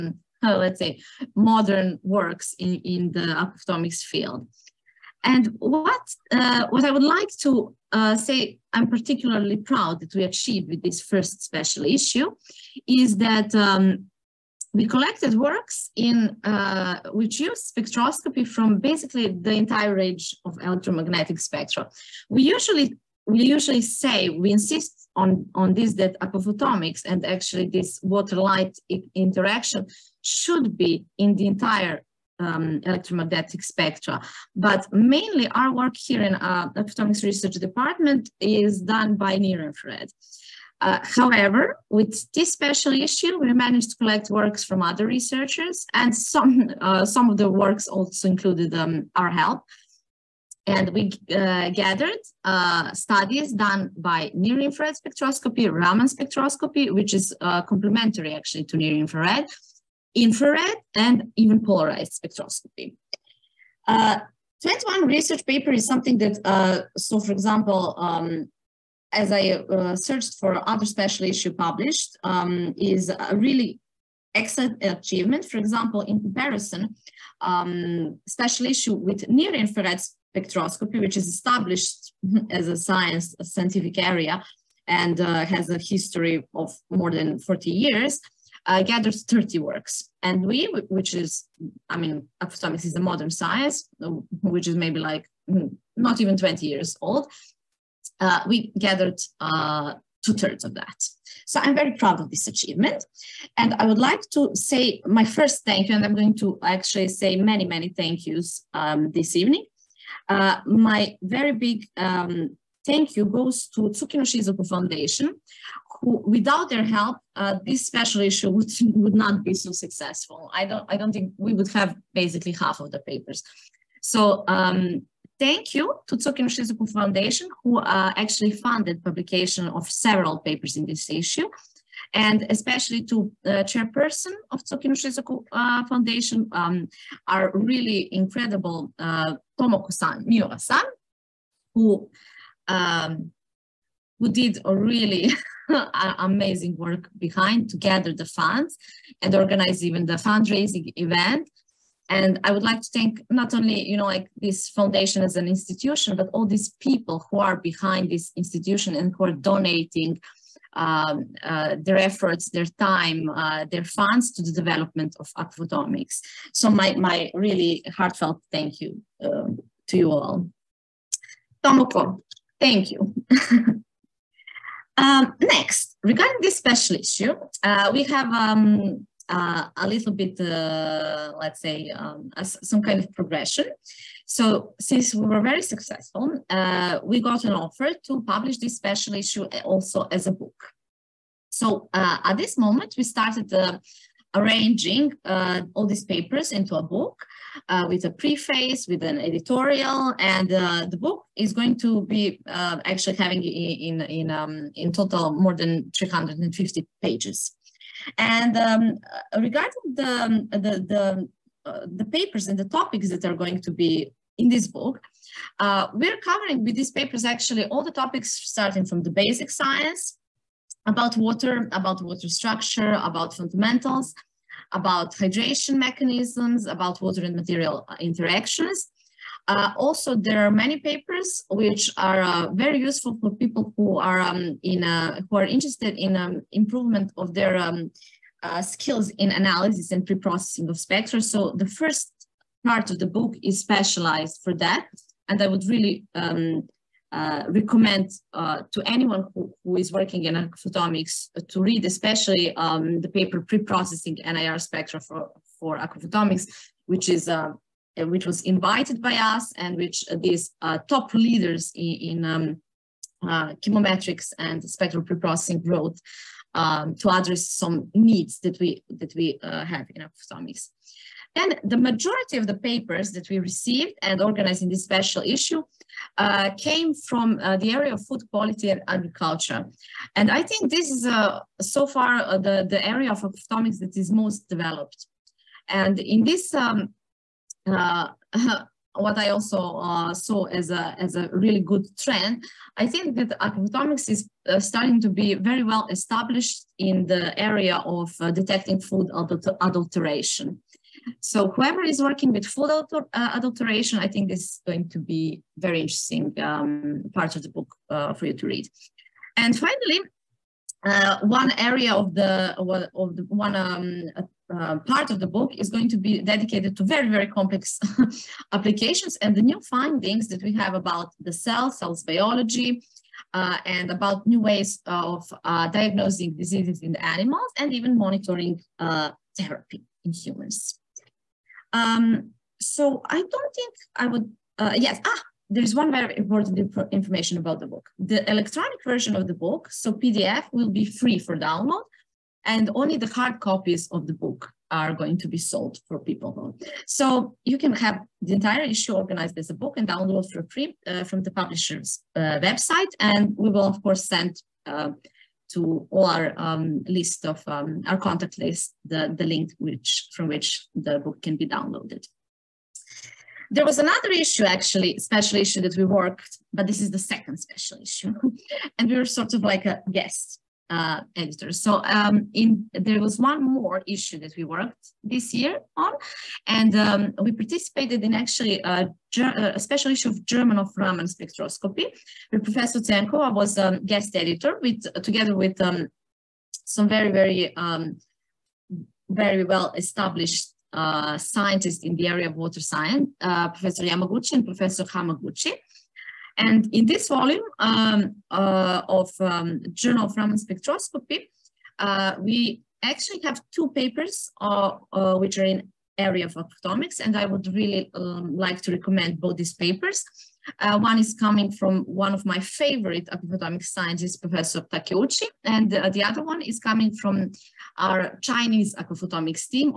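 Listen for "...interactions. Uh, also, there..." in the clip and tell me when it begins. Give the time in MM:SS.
03:48.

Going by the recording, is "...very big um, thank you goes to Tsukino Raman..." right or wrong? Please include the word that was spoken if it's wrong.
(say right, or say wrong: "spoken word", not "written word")
wrong: "Shizuku", not "Raman".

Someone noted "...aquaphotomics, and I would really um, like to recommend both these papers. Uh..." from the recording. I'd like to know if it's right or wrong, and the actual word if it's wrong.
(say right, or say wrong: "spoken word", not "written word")
right.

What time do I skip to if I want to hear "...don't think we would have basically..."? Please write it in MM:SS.
02:00.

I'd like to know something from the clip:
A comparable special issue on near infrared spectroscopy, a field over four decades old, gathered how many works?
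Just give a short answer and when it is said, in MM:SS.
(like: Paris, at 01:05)
30, at 01:29.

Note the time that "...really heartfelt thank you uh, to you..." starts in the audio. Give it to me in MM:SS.
02:47.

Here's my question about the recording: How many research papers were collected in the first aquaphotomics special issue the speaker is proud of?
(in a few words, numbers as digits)
21.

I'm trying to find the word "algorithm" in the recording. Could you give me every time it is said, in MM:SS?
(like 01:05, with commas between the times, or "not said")
not said.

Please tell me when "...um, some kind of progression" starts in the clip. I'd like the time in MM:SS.
03:01.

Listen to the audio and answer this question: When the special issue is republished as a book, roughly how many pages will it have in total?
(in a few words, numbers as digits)
more than 350.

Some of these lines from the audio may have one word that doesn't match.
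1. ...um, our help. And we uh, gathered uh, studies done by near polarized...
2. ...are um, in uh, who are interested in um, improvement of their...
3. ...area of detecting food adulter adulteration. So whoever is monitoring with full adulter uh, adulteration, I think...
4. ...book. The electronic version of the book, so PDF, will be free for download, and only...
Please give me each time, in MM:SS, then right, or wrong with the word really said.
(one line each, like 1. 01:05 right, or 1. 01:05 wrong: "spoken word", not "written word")
1. 00:48 wrong: "infrared", not "polarized"
2. 03:53 right
3. 04:57 wrong: "working", not "monitoring"
4. 05:37 right.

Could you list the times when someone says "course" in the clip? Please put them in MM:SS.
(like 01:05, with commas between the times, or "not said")
05:53.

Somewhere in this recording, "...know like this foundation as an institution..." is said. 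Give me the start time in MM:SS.
02:33.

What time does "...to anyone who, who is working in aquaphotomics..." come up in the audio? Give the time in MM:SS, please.
04:08.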